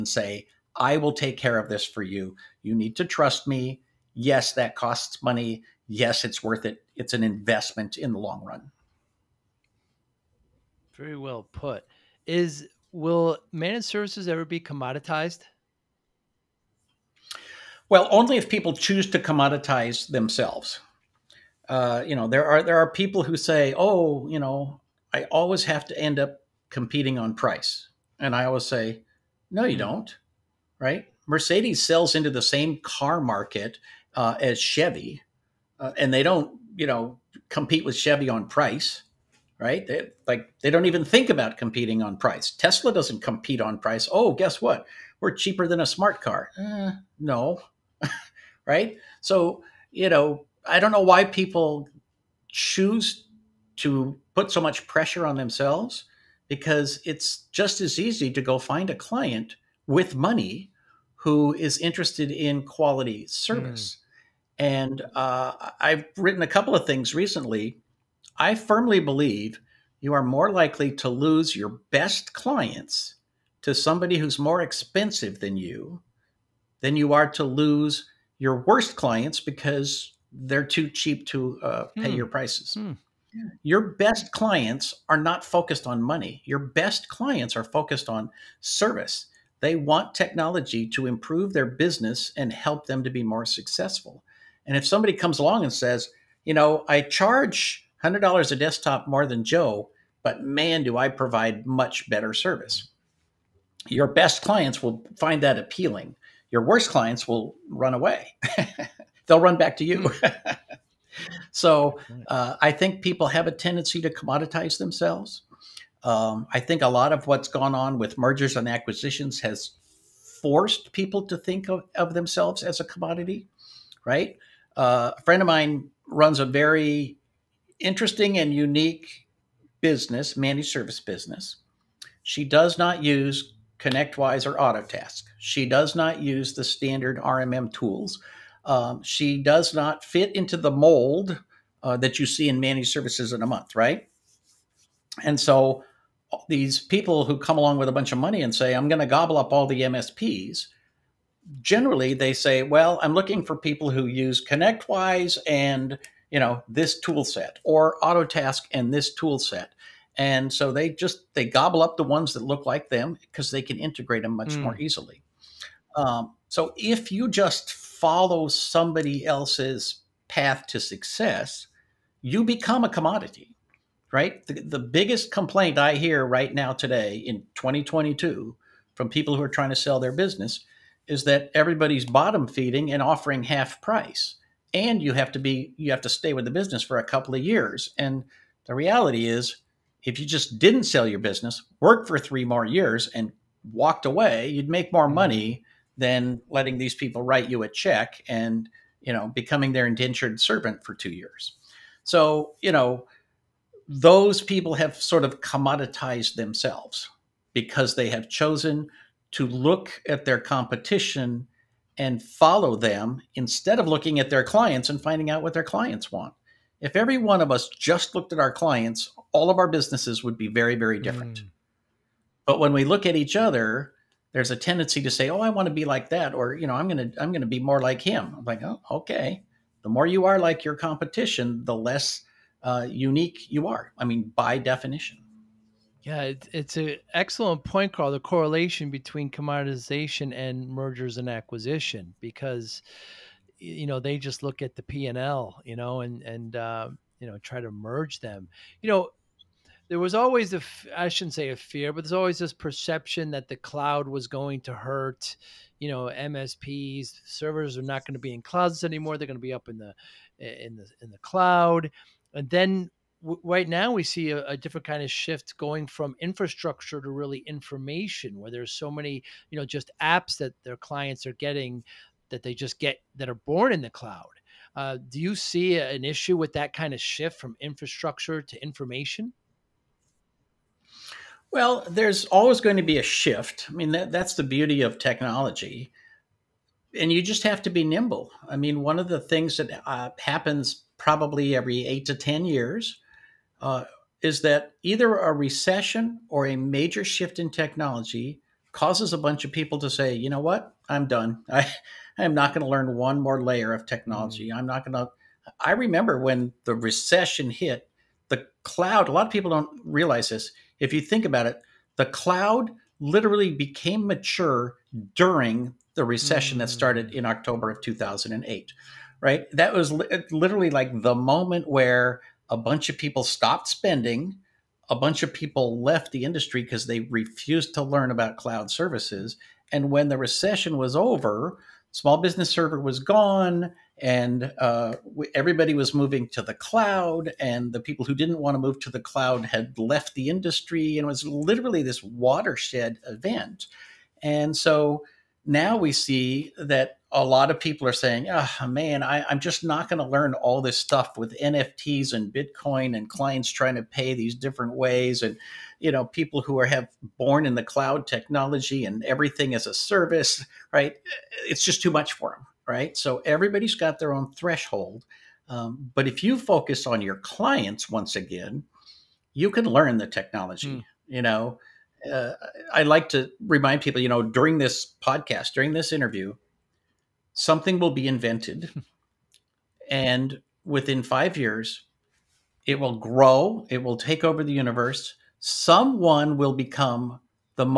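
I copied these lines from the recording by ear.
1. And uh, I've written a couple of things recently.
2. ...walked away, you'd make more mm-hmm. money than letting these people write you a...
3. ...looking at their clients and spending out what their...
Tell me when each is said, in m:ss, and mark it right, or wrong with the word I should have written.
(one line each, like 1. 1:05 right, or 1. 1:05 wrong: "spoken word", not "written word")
1. 1:04 right
2. 3:13 right
3. 3:33 wrong: "finding", not "spending".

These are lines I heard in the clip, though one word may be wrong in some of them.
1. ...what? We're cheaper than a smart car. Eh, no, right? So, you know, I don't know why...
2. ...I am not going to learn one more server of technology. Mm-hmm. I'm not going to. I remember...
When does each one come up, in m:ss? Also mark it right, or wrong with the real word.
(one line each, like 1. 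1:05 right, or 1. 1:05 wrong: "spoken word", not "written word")
1. 0:44 right
2. 5:02 wrong: "layer", not "server".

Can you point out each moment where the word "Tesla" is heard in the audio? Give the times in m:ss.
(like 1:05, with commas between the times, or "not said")
0:42.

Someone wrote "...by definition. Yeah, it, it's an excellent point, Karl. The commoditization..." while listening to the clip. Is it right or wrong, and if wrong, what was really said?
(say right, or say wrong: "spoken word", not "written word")
wrong: "correlation", not "commoditization".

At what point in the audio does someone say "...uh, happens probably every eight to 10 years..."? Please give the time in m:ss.
4:49.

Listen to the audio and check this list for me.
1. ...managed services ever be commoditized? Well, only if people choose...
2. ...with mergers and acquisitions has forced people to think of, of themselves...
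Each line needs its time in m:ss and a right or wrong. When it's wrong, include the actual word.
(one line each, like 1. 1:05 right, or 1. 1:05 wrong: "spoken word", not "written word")
1. 0:13 right
2. 1:57 right.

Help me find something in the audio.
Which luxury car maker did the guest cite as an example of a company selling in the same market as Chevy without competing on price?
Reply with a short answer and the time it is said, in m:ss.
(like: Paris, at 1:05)
Mercedes, at 0:31.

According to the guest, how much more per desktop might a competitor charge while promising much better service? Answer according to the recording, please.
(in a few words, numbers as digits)
$100.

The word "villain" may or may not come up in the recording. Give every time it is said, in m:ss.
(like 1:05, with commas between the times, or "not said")
not said.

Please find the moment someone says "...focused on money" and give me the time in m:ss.
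1:25.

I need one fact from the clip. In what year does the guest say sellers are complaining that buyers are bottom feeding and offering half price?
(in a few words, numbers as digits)
2022.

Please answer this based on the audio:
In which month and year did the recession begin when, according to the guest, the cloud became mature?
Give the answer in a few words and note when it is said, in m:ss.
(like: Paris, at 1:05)
October 2008, at 5:17.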